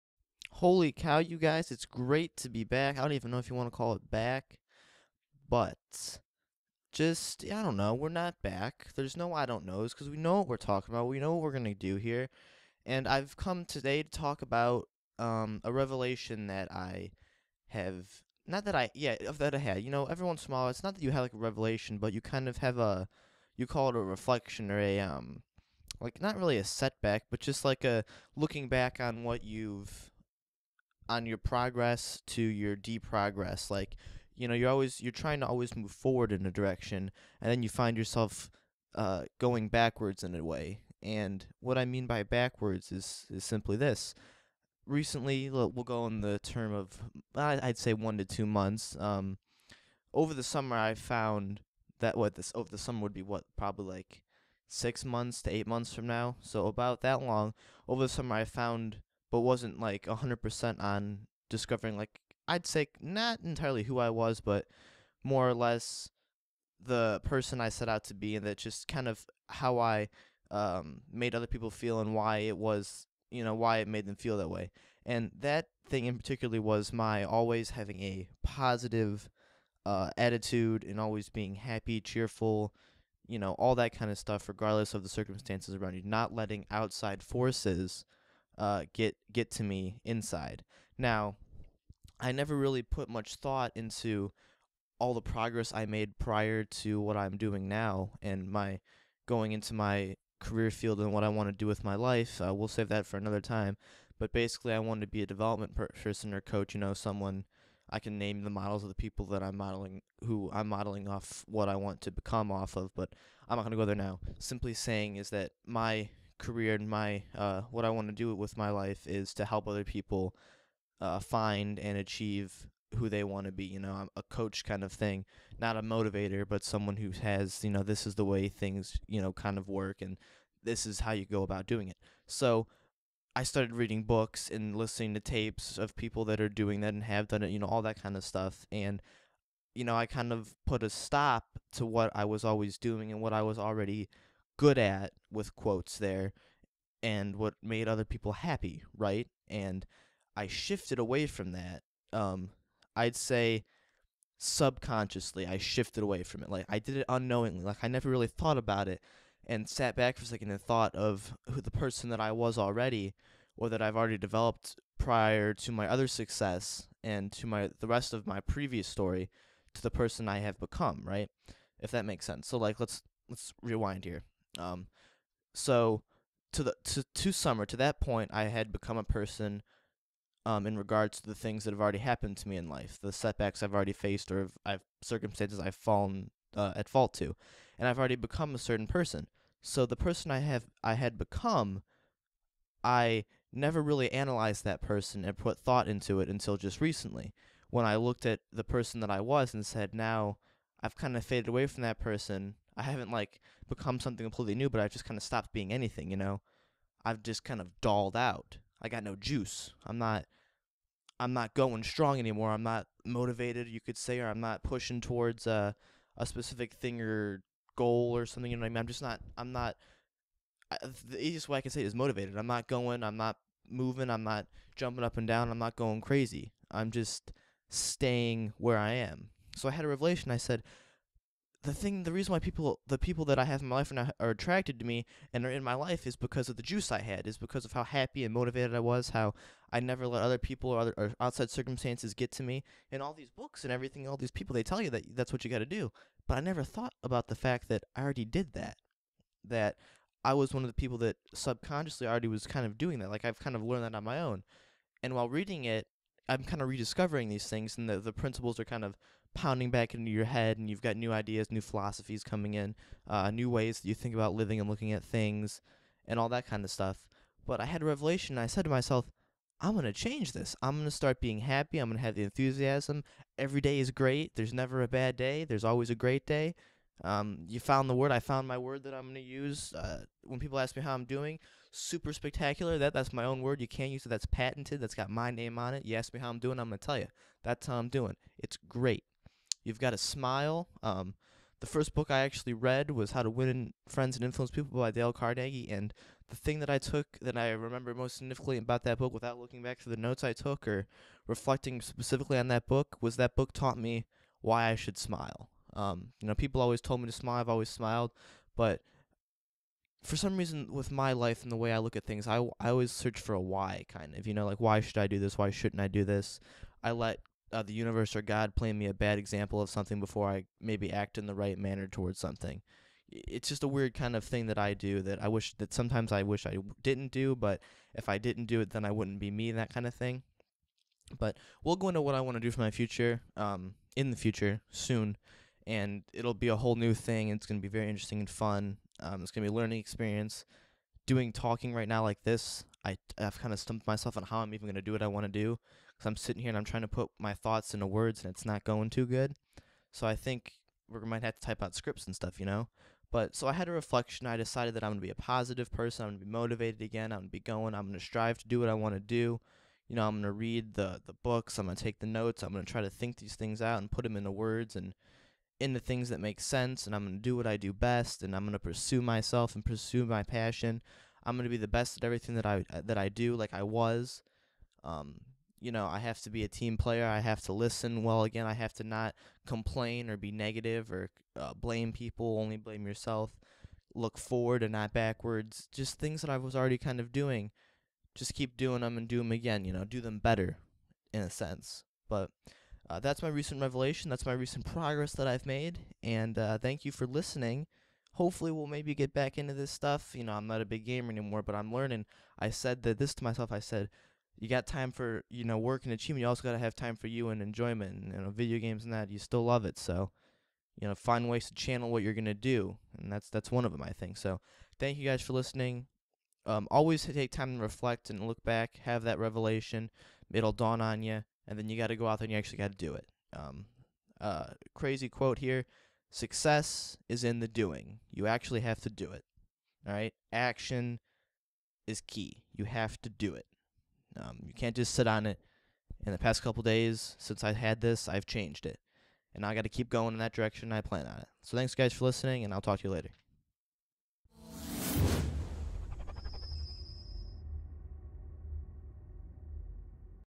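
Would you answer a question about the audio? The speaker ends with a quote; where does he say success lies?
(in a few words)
in the doing.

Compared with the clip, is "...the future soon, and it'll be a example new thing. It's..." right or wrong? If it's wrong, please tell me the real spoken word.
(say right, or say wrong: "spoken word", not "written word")
wrong: "whole", not "example".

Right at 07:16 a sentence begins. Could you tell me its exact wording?
In the past couple days since I had this, I've changed it.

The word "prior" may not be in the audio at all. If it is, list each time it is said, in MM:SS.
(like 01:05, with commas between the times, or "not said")
01:36, 02:44.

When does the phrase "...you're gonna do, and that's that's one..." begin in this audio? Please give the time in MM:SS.
06:52.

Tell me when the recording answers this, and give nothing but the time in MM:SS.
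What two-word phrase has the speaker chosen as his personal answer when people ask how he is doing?
04:41.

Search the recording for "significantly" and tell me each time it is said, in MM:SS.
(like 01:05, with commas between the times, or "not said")
04:58.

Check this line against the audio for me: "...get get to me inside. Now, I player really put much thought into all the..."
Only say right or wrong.
wrong.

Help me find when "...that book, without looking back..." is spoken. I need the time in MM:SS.
04:58.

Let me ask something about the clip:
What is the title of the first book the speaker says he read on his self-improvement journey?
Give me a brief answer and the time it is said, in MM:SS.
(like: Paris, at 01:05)
How to Win Friends and Influence People, at 04:53.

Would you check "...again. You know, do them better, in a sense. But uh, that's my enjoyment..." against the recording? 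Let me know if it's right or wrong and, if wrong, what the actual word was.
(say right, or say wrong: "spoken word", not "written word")
wrong: "recent", not "enjoyment".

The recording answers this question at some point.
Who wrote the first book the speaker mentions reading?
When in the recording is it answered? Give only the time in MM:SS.
04:54.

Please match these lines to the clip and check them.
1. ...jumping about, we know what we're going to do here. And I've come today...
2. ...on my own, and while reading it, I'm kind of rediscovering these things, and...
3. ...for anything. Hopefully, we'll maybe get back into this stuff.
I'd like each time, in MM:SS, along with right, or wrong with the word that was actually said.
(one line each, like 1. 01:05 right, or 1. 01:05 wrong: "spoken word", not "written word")
1. 00:10 wrong: "talking", not "jumping"
2. 04:13 right
3. 06:36 wrong: "listening", not "anything".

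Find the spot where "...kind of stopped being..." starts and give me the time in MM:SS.
03:25.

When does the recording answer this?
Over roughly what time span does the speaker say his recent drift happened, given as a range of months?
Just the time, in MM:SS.
00:47.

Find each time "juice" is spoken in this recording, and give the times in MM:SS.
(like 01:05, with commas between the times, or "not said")
03:29, 03:56.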